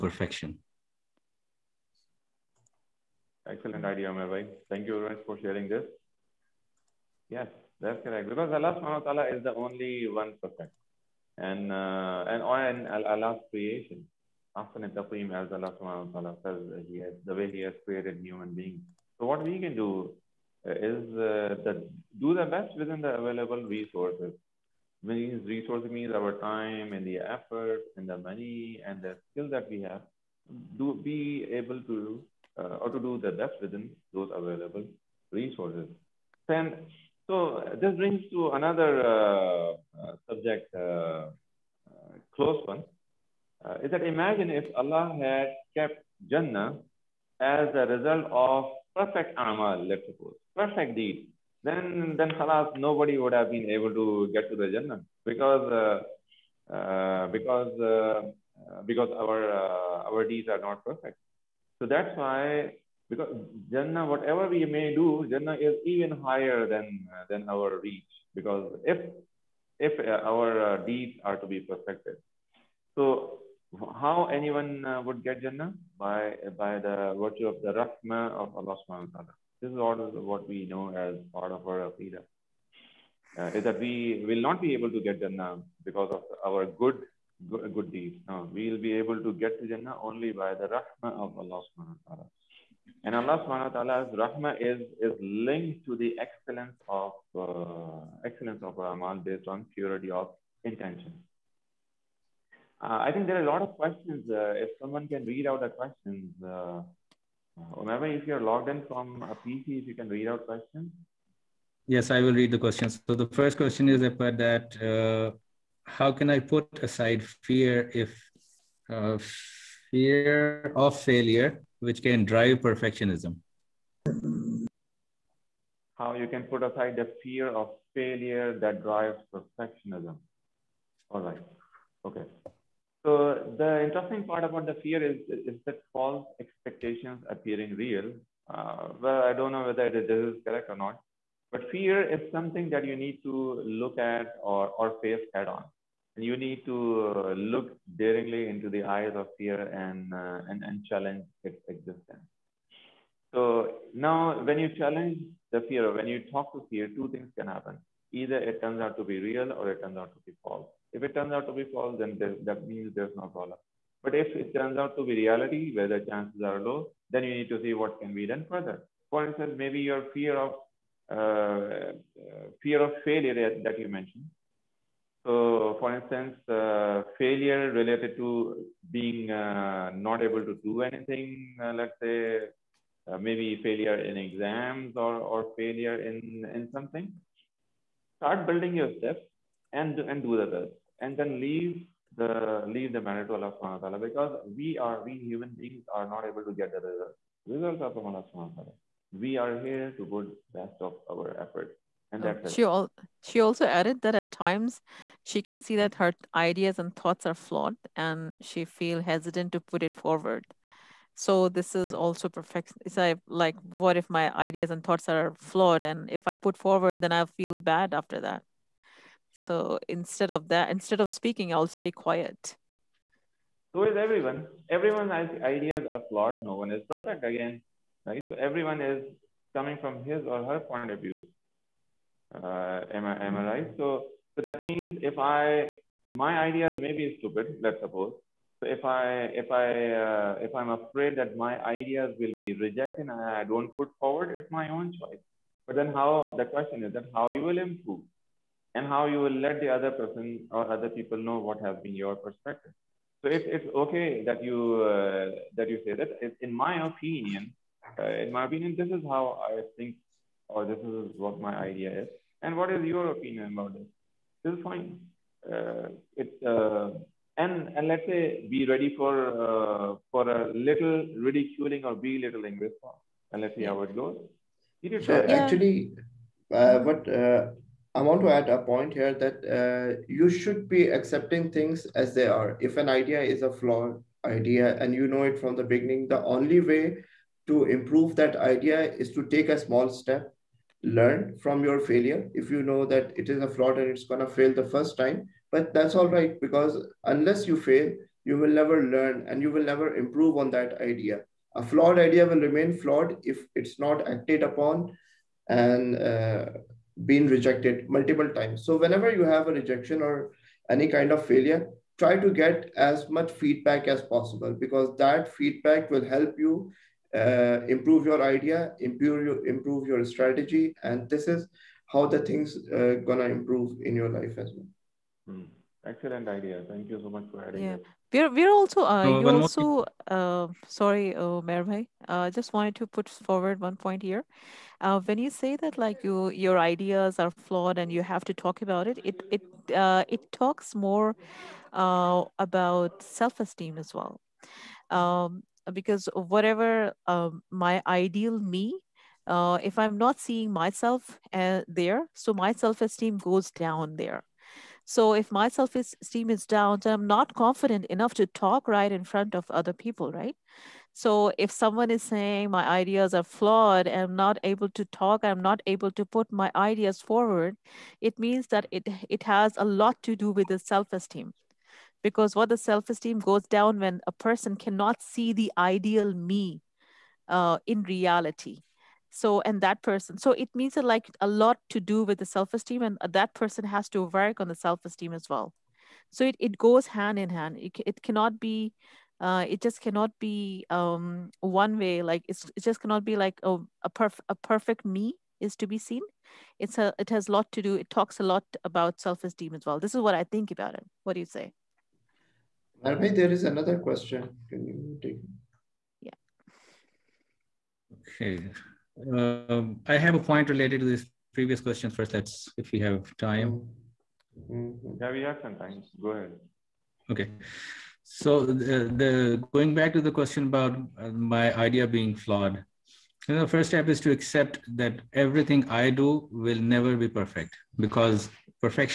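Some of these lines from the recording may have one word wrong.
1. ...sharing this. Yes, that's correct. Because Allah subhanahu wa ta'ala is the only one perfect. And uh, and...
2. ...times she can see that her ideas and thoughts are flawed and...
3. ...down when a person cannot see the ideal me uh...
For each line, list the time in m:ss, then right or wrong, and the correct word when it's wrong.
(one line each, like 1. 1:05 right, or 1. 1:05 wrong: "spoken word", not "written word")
1. 0:05 right
2. 3:24 right
3. 6:13 right.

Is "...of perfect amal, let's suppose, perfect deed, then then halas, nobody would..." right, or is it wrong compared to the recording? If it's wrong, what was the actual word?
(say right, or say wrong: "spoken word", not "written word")
right.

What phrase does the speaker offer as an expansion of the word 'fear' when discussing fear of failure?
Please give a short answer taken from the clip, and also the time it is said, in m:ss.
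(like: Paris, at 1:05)
false expectations appearing real, at 2:15.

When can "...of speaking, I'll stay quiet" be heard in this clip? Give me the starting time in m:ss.
3:41.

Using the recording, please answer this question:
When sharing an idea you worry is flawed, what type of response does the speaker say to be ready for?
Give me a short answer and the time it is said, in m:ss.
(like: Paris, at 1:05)
ridiculing or belittling, at 4:31.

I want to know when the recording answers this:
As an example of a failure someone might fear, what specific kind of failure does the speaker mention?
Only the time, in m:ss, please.
3:03.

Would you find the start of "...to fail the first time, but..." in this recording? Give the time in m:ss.
4:54.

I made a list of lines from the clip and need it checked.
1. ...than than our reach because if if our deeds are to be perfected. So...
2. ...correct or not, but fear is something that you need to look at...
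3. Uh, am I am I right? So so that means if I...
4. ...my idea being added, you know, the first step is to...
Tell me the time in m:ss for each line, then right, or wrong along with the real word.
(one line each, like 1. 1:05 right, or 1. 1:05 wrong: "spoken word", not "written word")
1. 1:06 right
2. 2:20 right
3. 3:52 right
4. 7:01 wrong: "flawed", not "added".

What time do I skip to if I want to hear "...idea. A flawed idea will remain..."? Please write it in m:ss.
5:00.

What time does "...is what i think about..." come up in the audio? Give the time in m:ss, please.
6:39.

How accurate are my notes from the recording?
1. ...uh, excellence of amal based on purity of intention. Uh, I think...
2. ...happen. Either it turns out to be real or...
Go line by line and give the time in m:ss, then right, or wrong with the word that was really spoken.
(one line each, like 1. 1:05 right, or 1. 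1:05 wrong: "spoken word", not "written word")
1. 1:37 right
2. 2:37 right.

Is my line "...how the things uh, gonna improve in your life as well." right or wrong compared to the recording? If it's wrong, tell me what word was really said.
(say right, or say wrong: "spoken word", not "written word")
right.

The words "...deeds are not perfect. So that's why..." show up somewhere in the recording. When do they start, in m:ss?
1:00.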